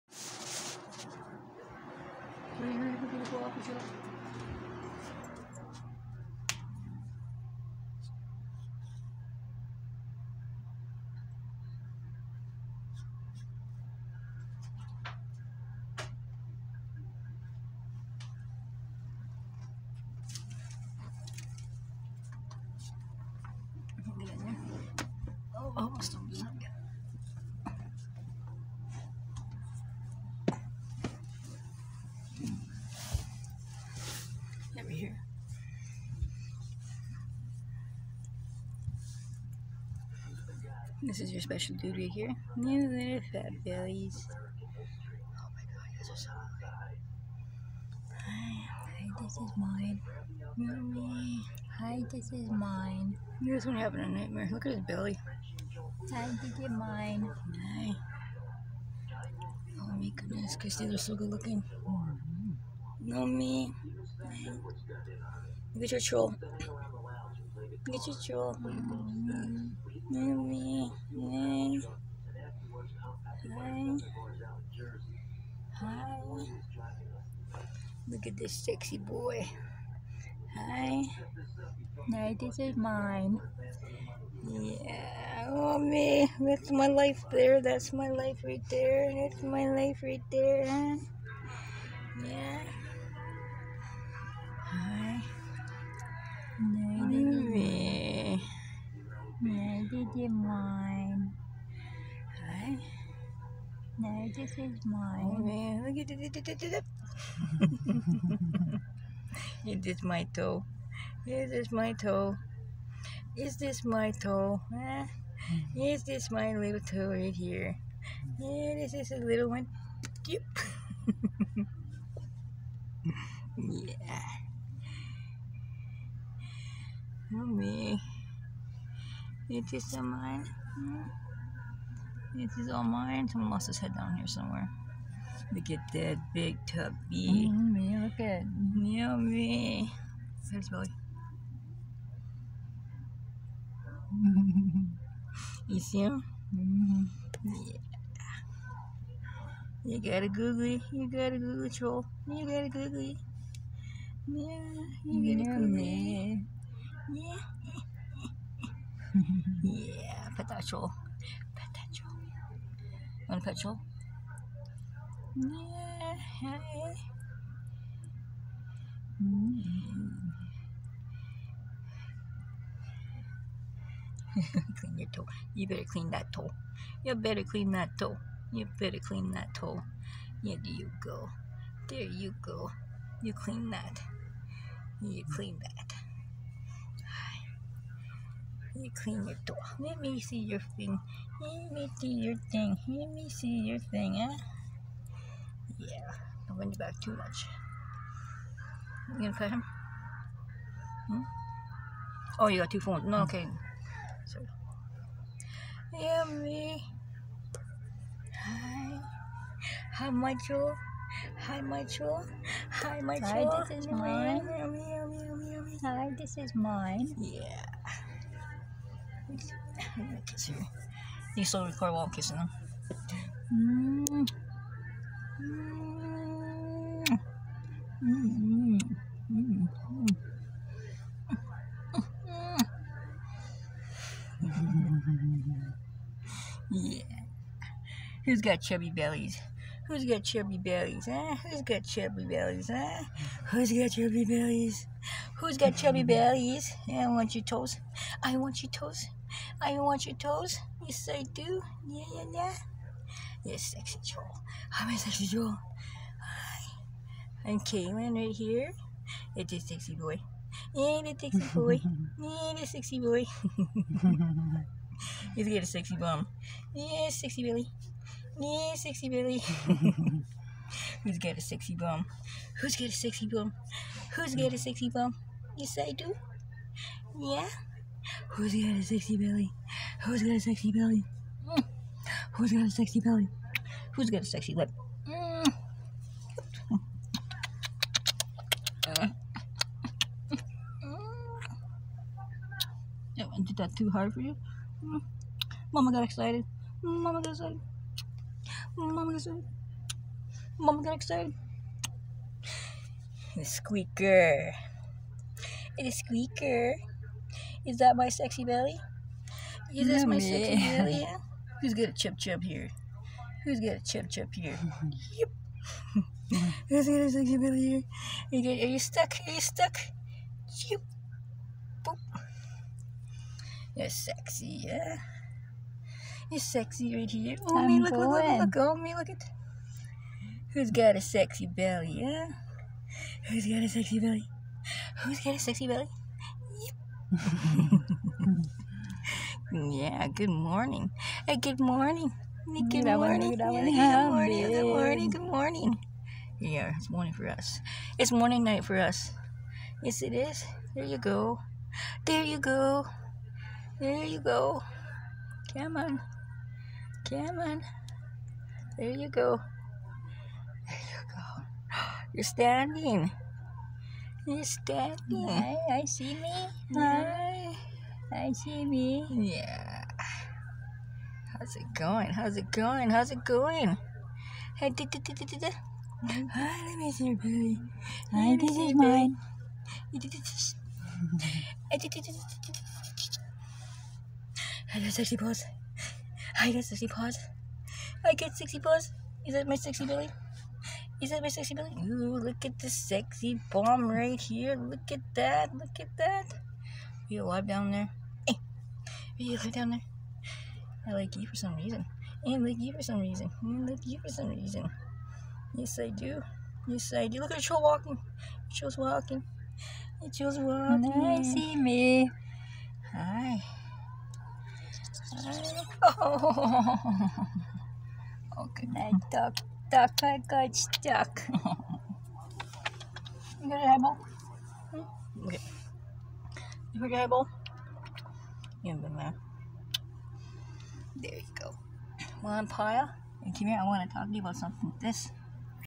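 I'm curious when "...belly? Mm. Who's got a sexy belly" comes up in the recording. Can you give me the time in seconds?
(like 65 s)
280 s.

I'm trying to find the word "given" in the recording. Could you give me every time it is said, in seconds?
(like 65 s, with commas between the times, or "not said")
not said.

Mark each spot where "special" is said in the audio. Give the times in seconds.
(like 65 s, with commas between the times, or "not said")
41 s.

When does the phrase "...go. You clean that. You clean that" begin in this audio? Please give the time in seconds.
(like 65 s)
182 s.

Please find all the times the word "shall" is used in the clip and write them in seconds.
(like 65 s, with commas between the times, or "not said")
not said.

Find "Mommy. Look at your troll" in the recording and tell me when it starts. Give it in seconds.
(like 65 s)
64 s.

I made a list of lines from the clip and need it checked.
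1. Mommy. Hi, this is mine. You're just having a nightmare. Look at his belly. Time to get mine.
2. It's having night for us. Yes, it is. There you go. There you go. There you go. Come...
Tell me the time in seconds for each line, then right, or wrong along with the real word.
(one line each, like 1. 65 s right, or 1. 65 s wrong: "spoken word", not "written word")
1. 50 s right
2. 347 s wrong: "morning", not "having".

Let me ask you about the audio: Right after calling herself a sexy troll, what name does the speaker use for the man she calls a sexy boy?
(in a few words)
Kaylin.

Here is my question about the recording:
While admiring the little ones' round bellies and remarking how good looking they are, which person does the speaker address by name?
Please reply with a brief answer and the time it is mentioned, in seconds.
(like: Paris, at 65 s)
Christy, at 60 s.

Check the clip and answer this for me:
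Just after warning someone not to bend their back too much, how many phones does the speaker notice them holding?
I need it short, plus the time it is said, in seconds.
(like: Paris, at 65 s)
2, at 202 s.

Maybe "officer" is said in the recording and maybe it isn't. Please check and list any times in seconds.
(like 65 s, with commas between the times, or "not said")
not said.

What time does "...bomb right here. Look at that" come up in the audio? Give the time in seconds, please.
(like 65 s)
393 s.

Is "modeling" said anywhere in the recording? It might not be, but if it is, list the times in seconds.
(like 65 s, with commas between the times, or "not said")
not said.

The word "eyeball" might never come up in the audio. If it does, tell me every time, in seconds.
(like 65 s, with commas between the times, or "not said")
423 s.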